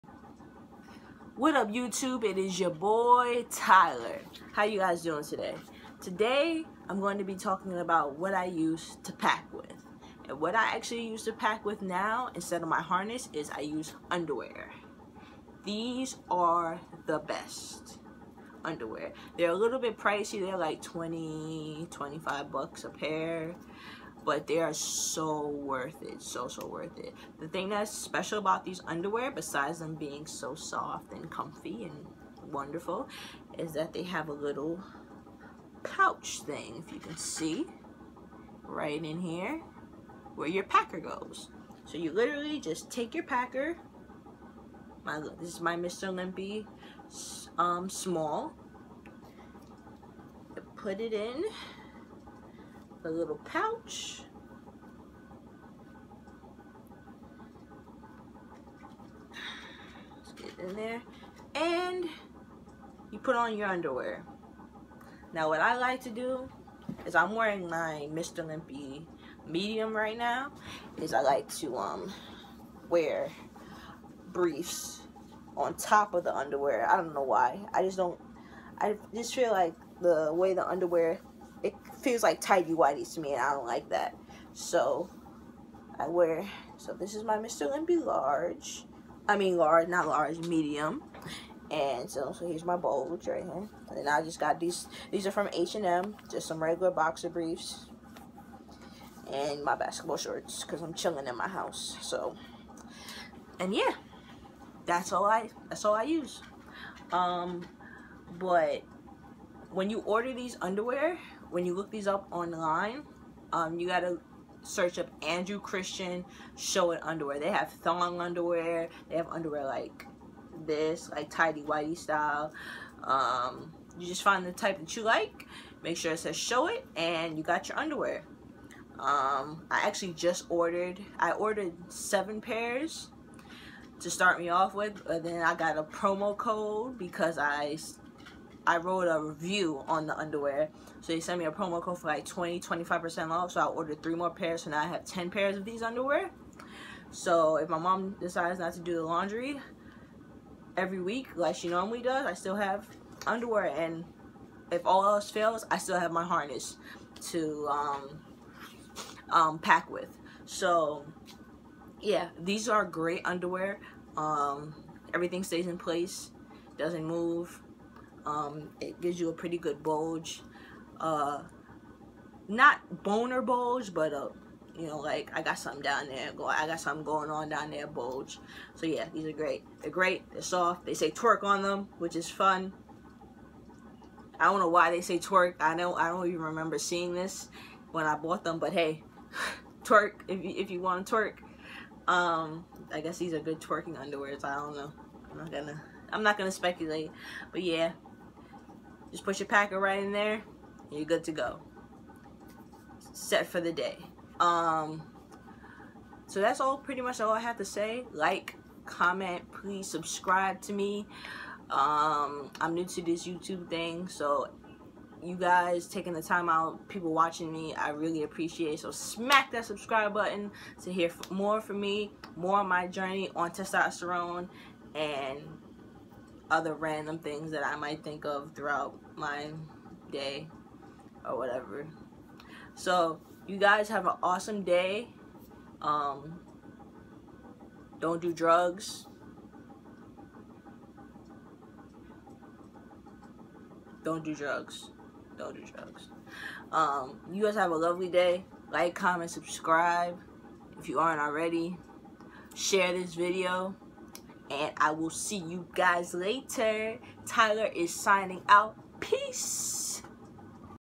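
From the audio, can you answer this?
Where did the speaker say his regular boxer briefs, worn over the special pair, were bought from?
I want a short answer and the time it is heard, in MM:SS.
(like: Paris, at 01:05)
H&M, at 01:35.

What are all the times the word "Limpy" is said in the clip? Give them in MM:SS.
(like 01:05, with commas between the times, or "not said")
00:46, 01:08, 01:27.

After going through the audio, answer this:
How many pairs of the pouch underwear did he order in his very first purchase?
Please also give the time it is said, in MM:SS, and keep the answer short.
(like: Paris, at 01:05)
7, at 02:11.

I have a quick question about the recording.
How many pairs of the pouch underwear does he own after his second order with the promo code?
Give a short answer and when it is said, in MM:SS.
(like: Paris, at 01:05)
10, at 02:25.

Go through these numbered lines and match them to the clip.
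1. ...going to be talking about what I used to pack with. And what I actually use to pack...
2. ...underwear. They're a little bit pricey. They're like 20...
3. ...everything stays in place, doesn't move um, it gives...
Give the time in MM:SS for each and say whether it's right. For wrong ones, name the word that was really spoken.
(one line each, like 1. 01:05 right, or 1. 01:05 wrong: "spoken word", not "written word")
1. 00:06 right
2. 00:18 right
3. 02:45 right.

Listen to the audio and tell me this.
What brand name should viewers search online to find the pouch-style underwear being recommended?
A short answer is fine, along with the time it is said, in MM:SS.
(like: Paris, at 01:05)
Andrew Christian, at 01:55.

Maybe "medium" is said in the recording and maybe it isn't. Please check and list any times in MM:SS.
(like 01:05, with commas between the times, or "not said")
01:09, 01:30.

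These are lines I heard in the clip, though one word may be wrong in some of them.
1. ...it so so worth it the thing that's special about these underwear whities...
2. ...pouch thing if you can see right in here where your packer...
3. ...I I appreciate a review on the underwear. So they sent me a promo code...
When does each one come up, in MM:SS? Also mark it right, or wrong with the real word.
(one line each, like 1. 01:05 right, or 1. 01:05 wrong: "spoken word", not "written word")
1. 00:26 wrong: "besides", not "whities"
2. 00:35 right
3. 02:17 wrong: "wrote", not "appreciate".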